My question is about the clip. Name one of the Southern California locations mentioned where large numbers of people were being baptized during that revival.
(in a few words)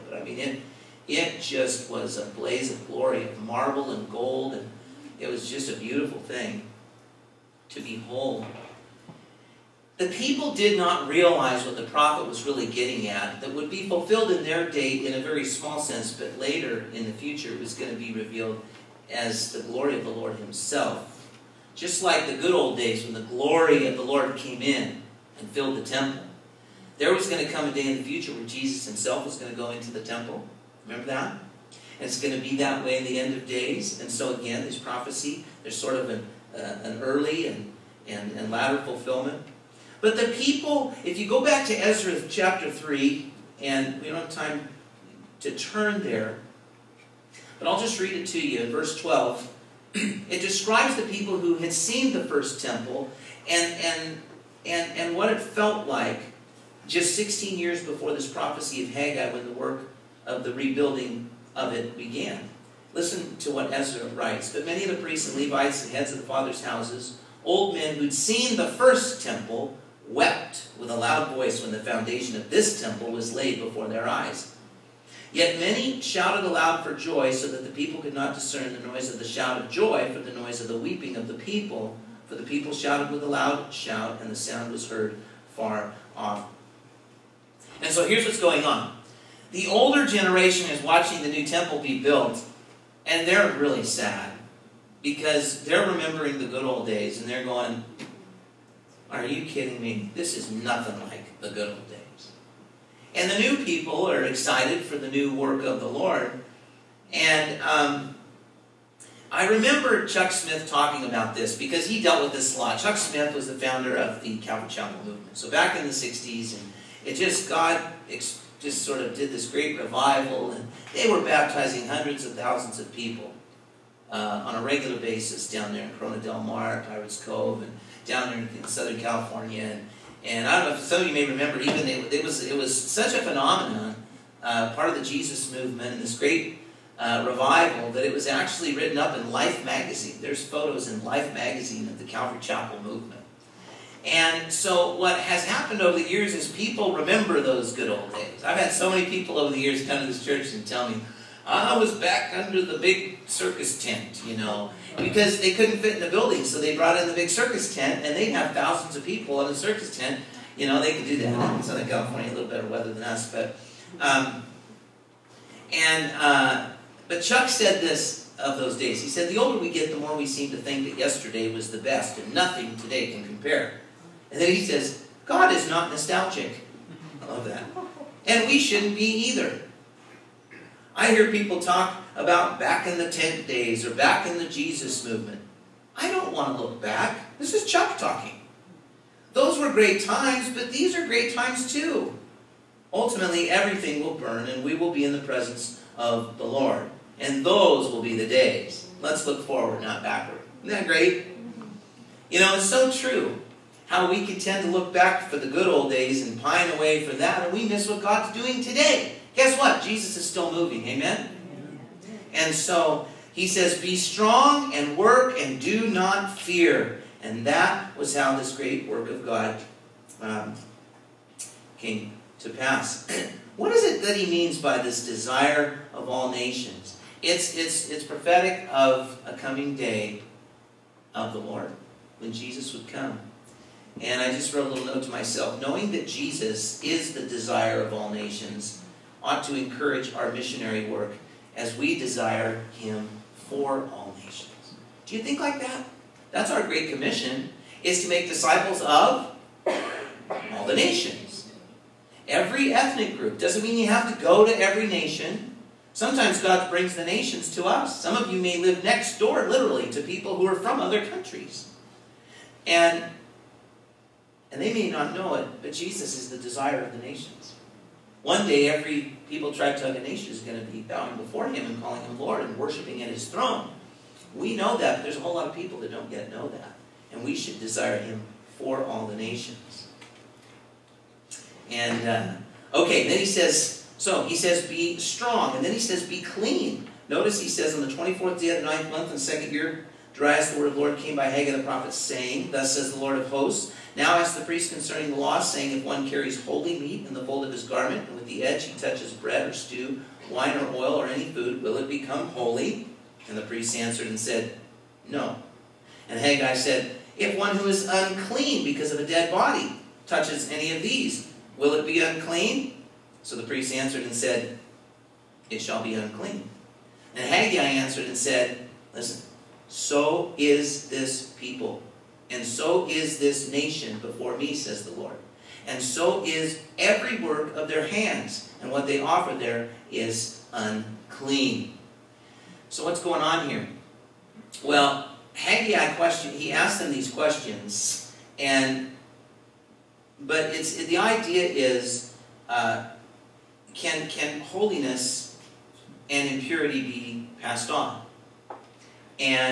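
Pirates Cove.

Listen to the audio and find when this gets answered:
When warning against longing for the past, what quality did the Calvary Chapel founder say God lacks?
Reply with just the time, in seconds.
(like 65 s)
175 s.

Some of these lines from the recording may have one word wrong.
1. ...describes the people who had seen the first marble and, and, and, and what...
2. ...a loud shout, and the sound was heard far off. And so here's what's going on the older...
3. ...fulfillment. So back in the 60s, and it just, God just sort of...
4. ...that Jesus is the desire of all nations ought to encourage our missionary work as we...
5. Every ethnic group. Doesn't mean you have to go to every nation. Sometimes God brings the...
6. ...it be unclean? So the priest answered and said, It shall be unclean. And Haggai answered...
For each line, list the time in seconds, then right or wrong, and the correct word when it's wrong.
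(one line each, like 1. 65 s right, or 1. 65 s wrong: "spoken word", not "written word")
1. 50 s wrong: "temple", not "marble"
2. 83 s right
3. 115 s wrong: "movement", not "fulfillment"
4. 235 s right
5. 252 s right
6. 311 s right.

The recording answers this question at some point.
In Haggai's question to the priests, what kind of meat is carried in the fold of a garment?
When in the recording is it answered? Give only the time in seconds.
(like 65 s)
296 s.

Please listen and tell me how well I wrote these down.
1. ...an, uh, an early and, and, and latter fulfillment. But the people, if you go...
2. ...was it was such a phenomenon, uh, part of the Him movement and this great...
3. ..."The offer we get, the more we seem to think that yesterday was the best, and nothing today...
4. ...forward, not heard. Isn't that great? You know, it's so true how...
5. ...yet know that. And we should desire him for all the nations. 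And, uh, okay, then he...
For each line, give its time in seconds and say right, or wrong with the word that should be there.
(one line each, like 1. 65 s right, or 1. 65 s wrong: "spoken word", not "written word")
1. 36 s right
2. 132 s wrong: "Jesus", not "Him"
3. 169 s wrong: "older", not "offer"
4. 199 s wrong: "backward", not "heard"
5. 276 s right.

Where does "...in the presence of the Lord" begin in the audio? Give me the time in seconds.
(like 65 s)
195 s.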